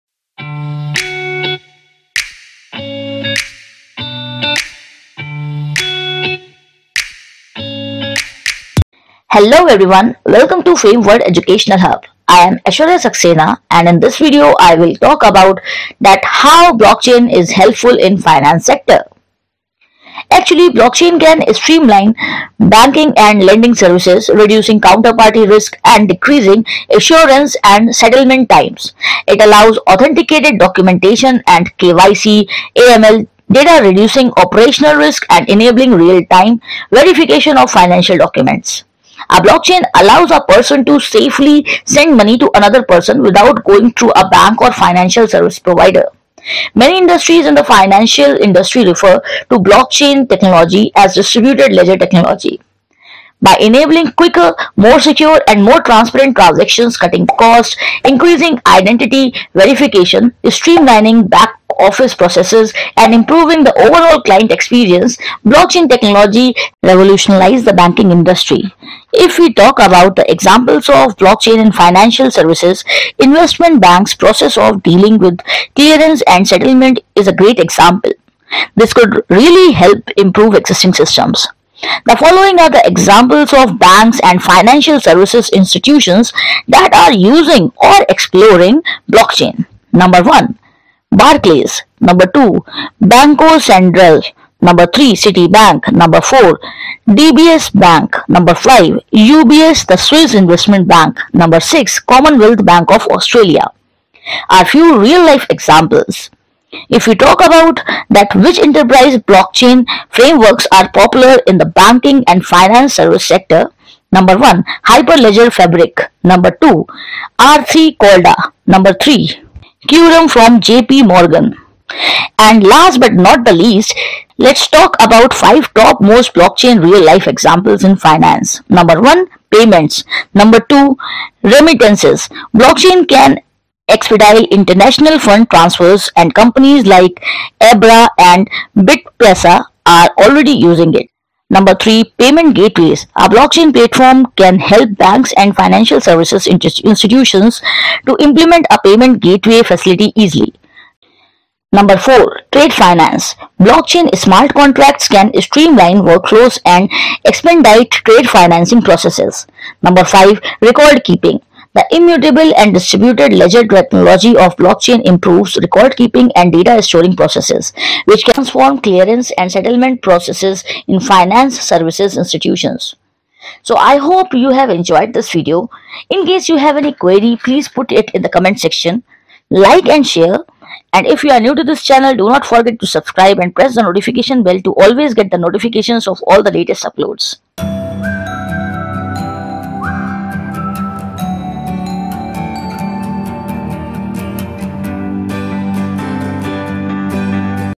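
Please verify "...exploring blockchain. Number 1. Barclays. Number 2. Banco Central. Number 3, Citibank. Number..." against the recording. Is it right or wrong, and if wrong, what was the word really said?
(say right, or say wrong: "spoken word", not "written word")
right.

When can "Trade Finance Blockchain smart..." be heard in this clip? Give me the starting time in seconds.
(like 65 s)
152 s.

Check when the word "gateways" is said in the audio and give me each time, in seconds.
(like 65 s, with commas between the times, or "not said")
142 s, 149 s.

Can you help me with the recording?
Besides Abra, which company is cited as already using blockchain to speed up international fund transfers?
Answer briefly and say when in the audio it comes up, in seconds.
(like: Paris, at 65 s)
BitPesa, at 138 s.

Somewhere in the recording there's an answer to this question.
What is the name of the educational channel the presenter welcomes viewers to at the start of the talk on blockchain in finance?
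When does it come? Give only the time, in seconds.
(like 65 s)
10 s.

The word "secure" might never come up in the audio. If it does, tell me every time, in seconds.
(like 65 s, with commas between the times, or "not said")
54 s.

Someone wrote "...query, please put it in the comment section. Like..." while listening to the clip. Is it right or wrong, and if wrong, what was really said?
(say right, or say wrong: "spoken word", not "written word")
right.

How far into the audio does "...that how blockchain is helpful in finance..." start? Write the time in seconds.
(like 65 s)
16 s.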